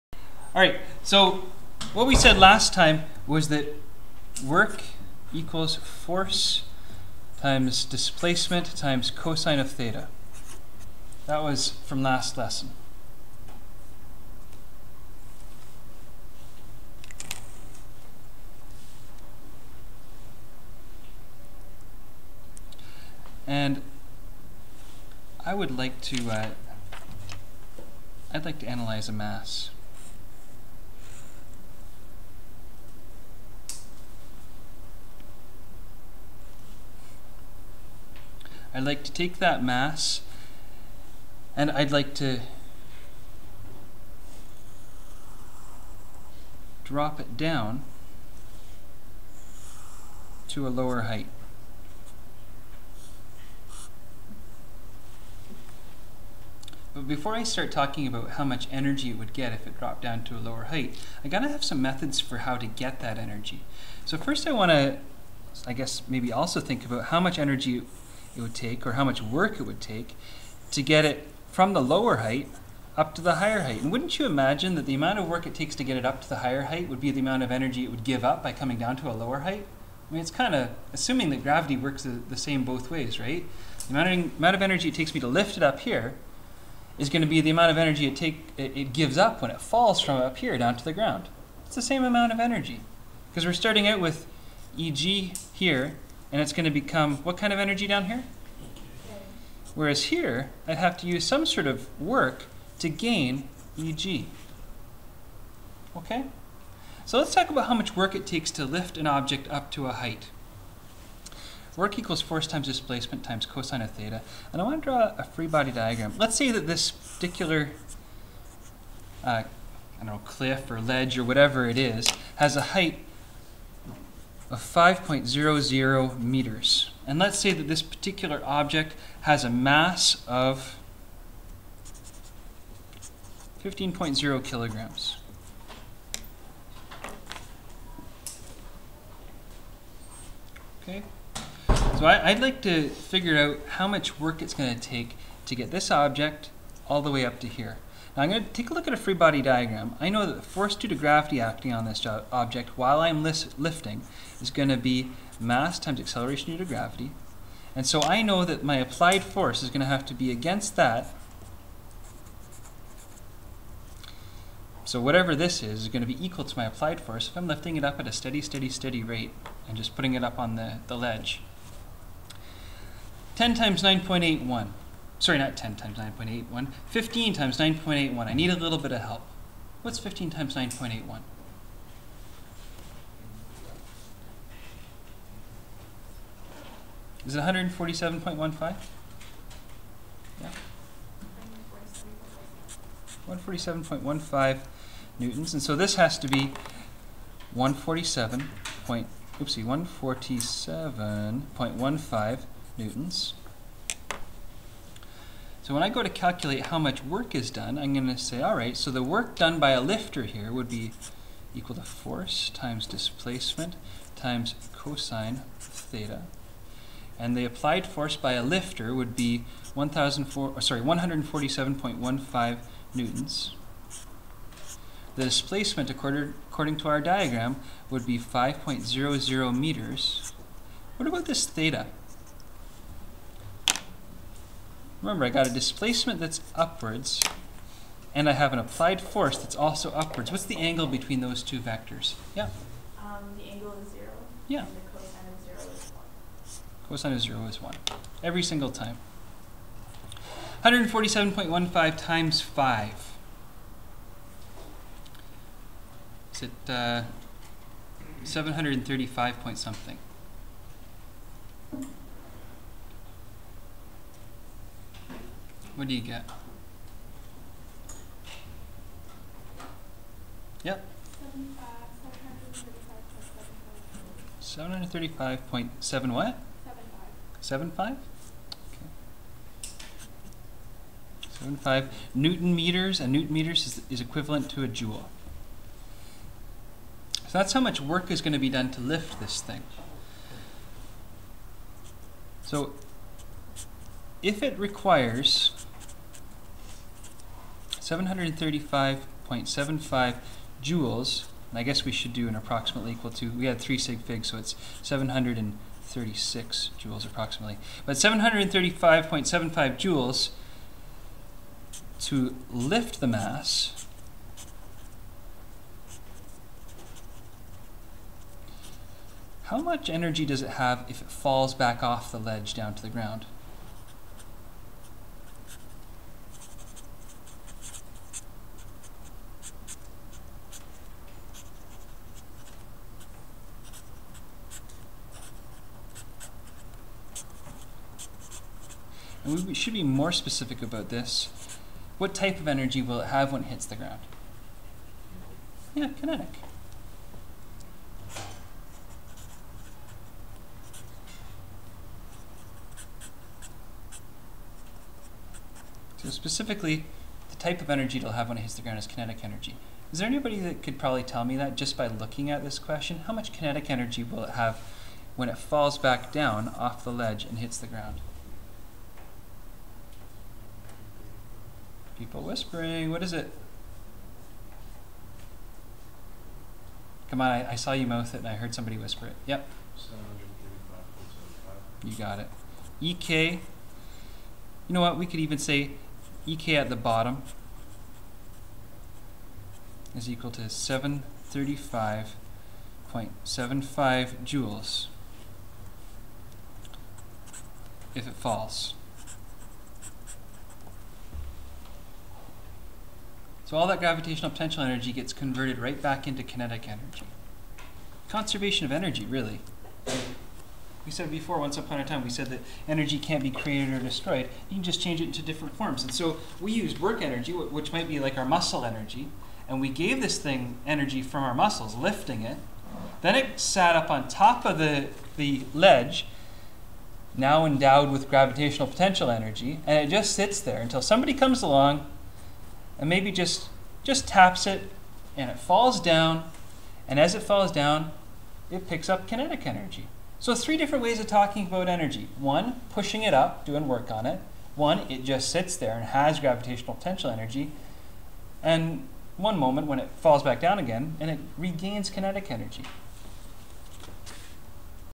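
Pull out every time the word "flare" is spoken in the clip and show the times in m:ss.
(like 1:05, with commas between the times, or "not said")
not said.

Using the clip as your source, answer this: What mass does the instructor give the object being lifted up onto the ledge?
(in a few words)
15.0 kilograms.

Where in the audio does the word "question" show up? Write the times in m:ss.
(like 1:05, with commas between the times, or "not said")
6:02.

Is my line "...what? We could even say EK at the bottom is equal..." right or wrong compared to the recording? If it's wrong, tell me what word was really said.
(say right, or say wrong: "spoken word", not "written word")
right.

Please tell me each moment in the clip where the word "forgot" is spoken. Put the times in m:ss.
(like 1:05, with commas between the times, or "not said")
not said.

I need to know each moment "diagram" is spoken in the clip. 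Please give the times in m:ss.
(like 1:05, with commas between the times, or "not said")
1:55, 2:29, 3:47.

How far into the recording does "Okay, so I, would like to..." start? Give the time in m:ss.
2:20.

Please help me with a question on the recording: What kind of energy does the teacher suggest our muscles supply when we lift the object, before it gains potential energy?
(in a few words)
work energy.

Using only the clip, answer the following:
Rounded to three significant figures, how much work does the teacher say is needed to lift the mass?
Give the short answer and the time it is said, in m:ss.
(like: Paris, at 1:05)
736 joules, at 5:04.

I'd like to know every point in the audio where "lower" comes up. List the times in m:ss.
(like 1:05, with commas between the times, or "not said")
0:50, 1:00, 1:11, 1:19.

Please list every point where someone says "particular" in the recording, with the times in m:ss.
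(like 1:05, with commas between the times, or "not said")
1:56, 2:07.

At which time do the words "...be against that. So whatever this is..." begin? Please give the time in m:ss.
2:40.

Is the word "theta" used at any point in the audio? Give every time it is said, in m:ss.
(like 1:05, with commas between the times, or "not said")
0:09, 1:53, 3:35, 3:51.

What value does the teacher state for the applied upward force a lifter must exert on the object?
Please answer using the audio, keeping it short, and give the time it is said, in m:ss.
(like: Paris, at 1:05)
147.15 newtons, at 3:40.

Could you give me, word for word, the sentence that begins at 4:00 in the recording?
What's the angle between those two vectors?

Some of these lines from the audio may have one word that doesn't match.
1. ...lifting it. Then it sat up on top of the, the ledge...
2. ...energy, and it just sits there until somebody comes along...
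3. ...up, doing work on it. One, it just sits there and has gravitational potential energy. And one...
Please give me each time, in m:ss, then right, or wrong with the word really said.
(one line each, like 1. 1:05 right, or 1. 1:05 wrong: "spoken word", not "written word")
1. 7:01 right
2. 7:09 right
3. 7:23 right.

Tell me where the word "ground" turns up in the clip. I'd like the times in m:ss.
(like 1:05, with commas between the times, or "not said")
1:30, 5:22, 5:43, 5:58, 6:07.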